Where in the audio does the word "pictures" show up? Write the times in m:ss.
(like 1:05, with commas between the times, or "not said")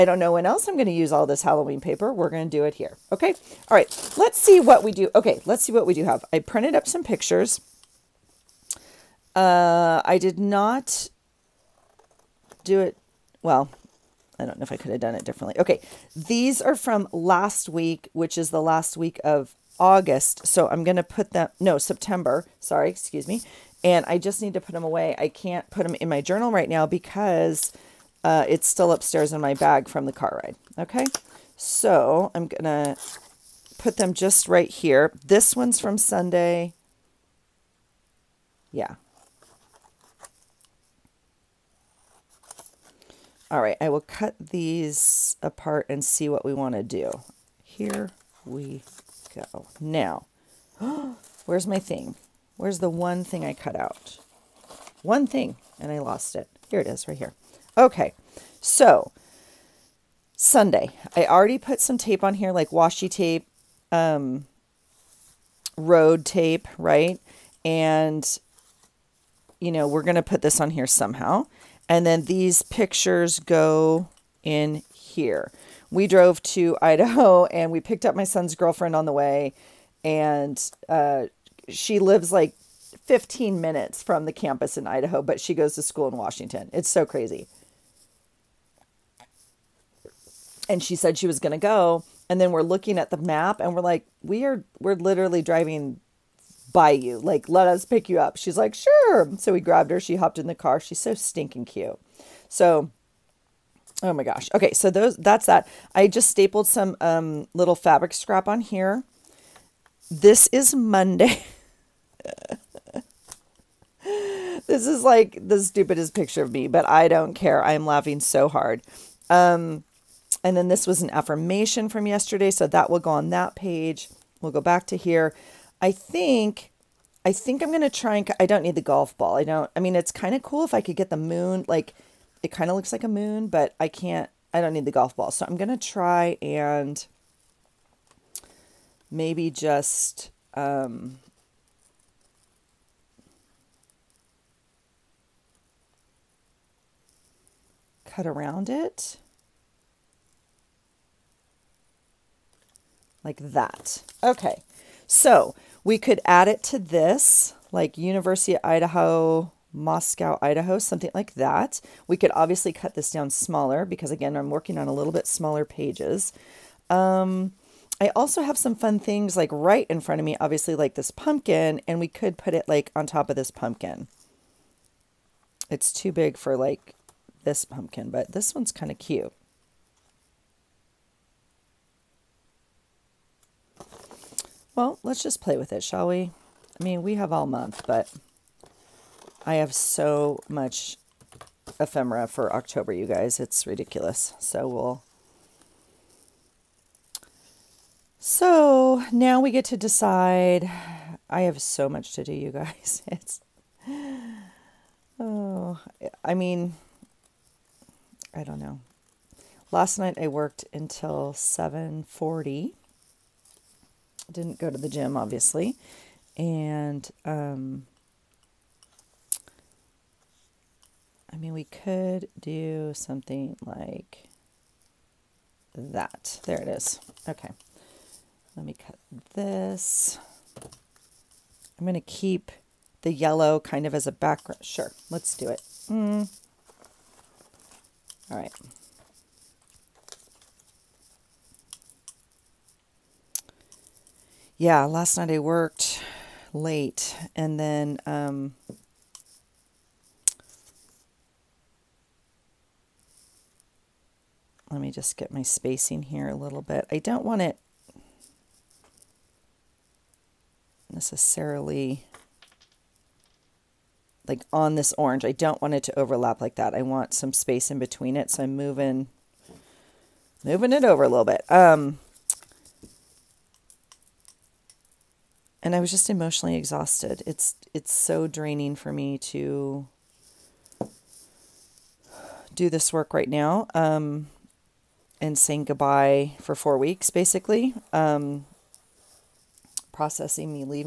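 0:07, 1:12, 1:56.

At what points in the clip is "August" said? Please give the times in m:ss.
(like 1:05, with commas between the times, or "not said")
0:19.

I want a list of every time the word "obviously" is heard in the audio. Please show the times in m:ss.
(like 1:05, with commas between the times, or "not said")
2:42, 2:50, 3:35.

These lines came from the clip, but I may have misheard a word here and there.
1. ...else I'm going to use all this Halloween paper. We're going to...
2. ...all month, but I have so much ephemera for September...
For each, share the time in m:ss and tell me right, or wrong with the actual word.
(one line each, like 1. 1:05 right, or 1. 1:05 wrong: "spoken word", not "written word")
1. 0:00 right
2. 3:07 wrong: "October", not "September".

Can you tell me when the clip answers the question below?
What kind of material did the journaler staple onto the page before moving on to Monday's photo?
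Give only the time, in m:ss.
1:47.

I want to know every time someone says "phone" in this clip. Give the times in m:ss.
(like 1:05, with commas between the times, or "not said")
not said.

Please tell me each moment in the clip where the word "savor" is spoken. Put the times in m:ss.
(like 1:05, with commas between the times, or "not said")
not said.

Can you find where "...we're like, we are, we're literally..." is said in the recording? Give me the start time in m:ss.
1:33.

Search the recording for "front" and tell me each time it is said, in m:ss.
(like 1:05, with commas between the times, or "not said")
2:50.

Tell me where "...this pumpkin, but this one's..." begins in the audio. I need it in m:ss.
2:57.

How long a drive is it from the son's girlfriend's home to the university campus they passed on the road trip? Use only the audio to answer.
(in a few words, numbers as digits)
15 minutes.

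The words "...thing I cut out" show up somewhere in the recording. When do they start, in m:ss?
0:53.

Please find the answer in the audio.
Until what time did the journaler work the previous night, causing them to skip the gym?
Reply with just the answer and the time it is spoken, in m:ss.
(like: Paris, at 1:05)
7:40, at 3:31.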